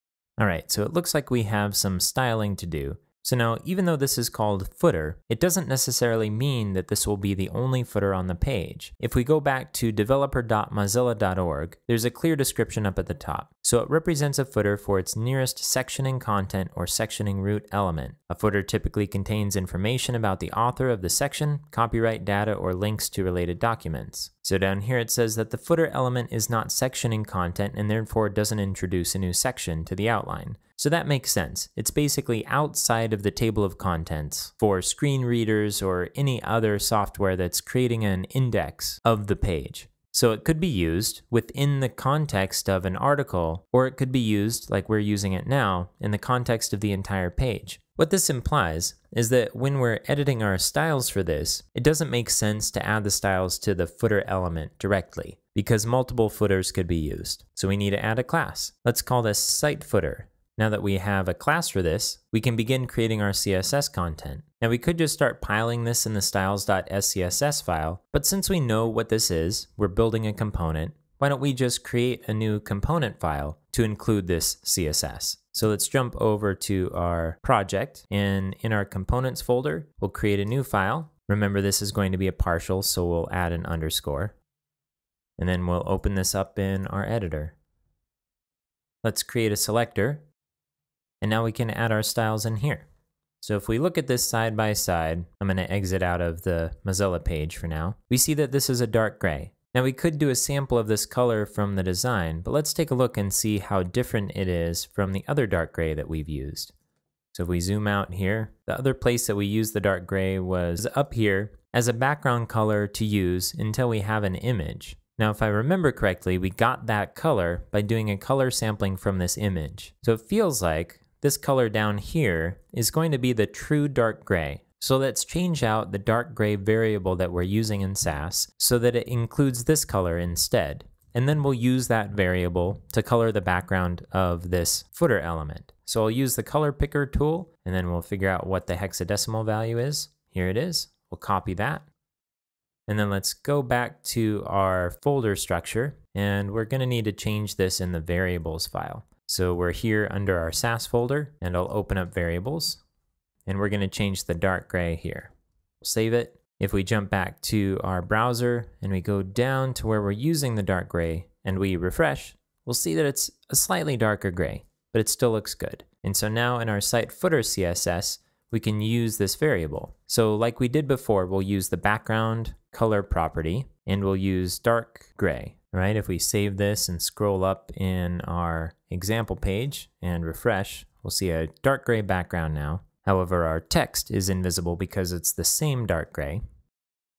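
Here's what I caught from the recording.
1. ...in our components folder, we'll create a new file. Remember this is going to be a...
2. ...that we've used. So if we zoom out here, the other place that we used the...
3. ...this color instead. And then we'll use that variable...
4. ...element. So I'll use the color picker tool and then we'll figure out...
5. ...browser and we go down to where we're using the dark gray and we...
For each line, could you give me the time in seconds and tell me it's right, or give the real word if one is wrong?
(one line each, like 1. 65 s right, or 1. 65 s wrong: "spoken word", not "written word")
1. 78 s right
2. 105 s right
3. 129 s right
4. 135 s right
5. 158 s right.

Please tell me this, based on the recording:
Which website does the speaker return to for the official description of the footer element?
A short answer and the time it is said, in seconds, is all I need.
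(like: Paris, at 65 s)
developer.mozilla.org, at 9 s.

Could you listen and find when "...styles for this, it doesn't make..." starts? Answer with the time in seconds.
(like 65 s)
50 s.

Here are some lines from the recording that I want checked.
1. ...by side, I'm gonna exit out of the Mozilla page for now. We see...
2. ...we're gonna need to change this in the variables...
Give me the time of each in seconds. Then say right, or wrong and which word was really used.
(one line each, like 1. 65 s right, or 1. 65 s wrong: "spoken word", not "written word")
1. 94 s right
2. 146 s right.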